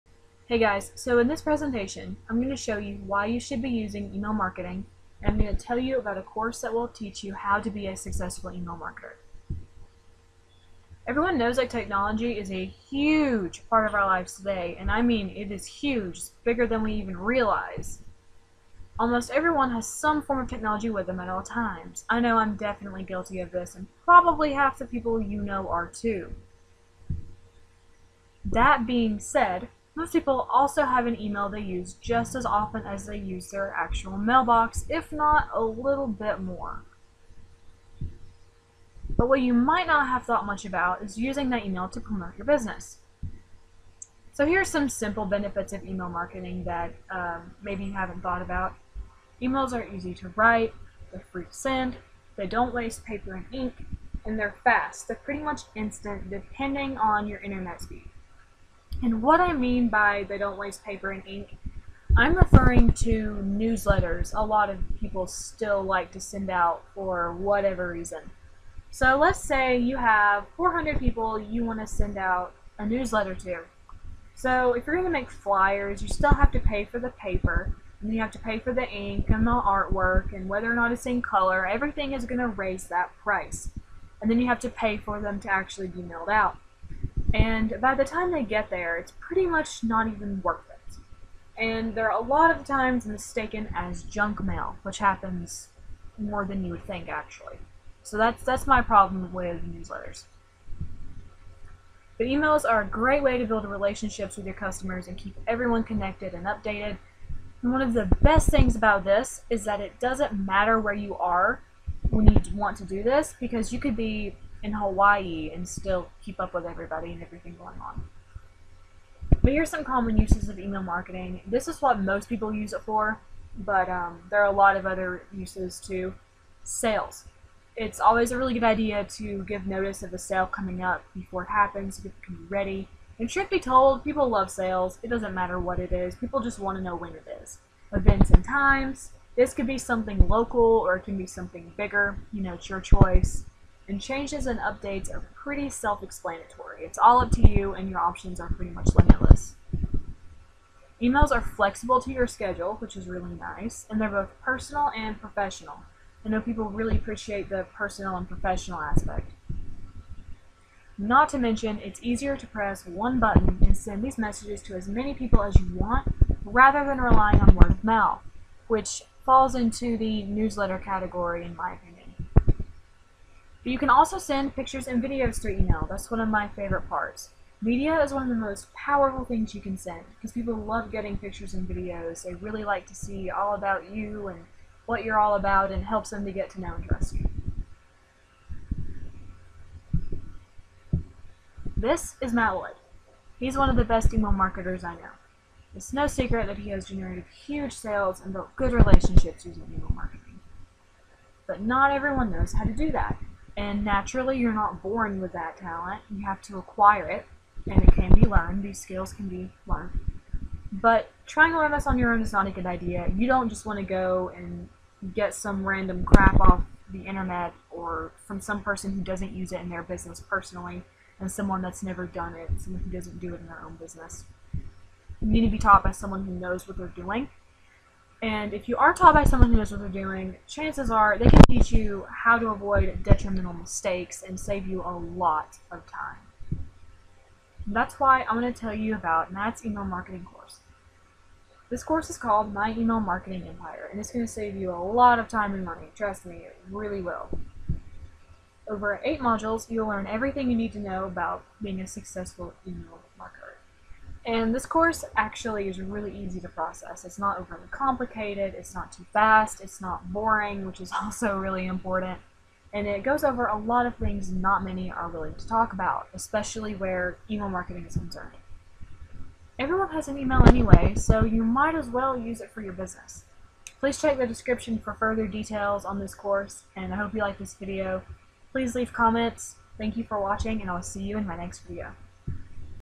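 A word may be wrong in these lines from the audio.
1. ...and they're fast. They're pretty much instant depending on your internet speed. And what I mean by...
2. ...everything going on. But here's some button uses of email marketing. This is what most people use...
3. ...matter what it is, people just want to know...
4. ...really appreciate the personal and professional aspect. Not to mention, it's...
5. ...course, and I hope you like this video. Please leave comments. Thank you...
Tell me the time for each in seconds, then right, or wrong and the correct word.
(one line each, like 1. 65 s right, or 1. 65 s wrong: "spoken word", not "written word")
1. 54 s right
2. 117 s wrong: "common", not "button"
3. 135 s right
4. 156 s right
5. 276 s right.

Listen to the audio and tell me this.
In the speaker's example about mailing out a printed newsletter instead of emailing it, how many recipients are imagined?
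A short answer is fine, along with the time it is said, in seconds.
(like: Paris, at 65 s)
400, at 70 s.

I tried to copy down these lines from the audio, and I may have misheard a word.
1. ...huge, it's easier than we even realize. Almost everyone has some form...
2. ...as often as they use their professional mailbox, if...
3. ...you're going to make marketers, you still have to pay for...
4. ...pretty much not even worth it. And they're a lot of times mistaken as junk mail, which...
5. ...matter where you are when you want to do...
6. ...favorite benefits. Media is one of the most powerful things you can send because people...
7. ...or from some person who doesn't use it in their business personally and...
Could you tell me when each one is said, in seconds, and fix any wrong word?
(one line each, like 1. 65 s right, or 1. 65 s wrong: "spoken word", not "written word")
1. 15 s wrong: "bigger", not "easier"
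2. 32 s wrong: "actual", not "professional"
3. 74 s wrong: "flyers", not "marketers"
4. 89 s right
5. 110 s right
6. 176 s wrong: "parts", not "benefits"
7. 217 s right.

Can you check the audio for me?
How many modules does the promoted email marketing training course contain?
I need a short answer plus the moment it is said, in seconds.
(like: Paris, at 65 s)
8, at 249 s.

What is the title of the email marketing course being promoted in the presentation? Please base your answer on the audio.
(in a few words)
My Email Marketing Empire.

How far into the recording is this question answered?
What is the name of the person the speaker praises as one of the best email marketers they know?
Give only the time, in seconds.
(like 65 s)
192 s.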